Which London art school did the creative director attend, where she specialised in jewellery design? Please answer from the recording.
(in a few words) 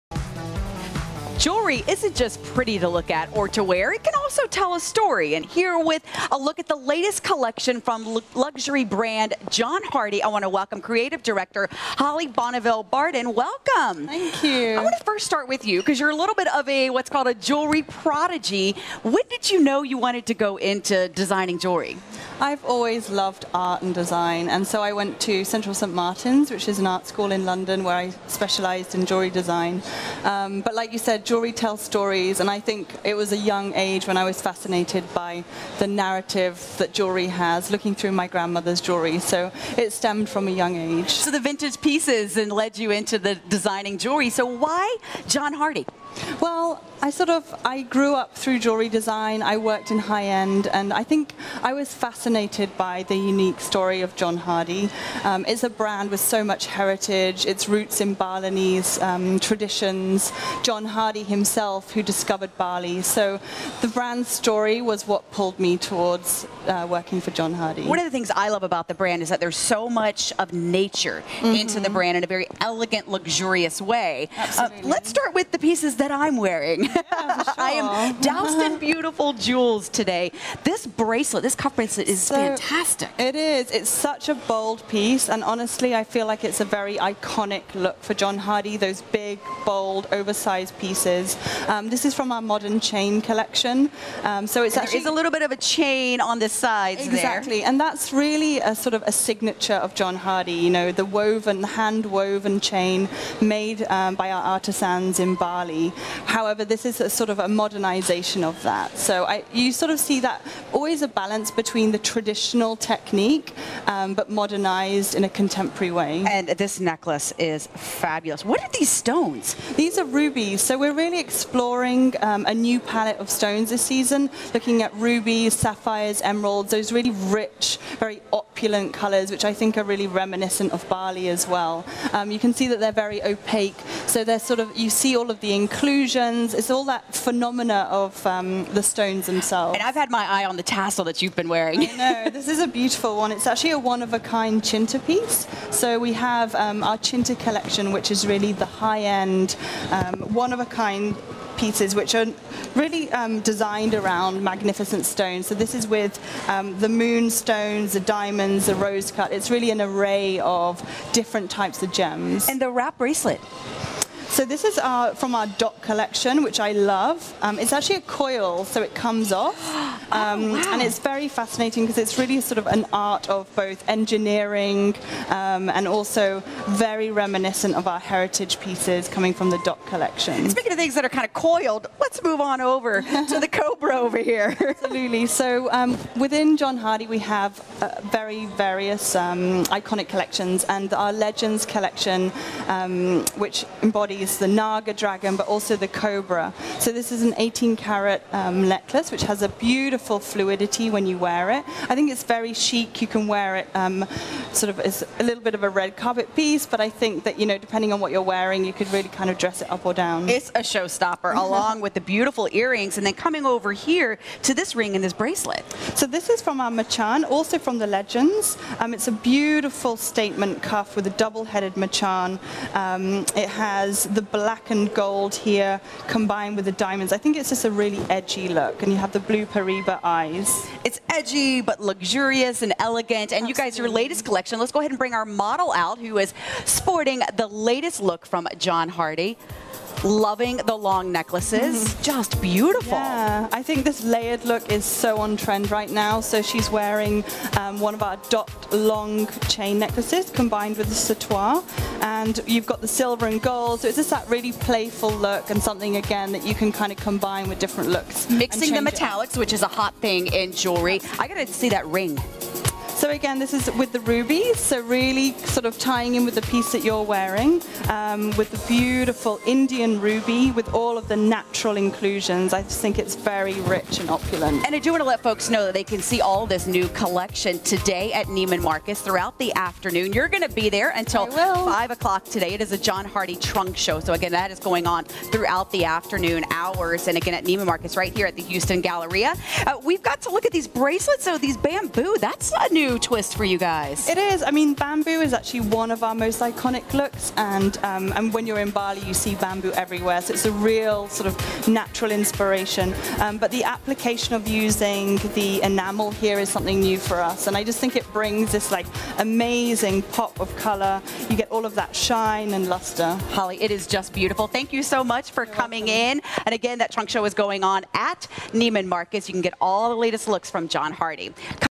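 Central St Martin's.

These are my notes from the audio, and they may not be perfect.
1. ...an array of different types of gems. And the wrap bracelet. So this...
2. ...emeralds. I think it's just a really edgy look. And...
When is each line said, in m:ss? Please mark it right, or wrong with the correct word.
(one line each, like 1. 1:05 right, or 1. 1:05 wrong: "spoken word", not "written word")
1. 2:39 right
2. 3:46 wrong: "diamonds", not "emeralds".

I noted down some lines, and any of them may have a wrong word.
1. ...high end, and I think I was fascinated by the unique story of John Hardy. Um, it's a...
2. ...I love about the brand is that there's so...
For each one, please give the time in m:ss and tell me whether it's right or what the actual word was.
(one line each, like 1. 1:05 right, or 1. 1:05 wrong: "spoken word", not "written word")
1. 0:49 right
2. 1:08 right.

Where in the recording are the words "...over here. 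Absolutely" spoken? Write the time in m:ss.
3:03.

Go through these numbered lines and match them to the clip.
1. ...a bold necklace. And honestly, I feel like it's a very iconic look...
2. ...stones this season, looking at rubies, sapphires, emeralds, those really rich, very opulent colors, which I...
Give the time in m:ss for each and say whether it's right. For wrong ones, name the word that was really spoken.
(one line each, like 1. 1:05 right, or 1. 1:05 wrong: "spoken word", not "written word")
1. 1:24 wrong: "piece", not "necklace"
2. 2:03 right.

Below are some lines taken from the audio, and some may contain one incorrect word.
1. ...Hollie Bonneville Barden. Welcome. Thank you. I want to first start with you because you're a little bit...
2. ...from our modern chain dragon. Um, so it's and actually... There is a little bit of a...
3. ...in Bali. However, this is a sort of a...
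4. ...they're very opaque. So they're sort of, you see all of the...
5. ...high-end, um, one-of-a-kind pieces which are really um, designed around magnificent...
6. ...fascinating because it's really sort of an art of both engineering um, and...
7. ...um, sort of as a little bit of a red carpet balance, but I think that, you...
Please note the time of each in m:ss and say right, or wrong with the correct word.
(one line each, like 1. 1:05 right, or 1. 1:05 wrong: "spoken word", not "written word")
1. 0:11 right
2. 1:32 wrong: "collection", not "dragon"
3. 1:45 right
4. 2:12 right
5. 2:28 right
6. 2:51 right
7. 3:23 wrong: "piece", not "balance".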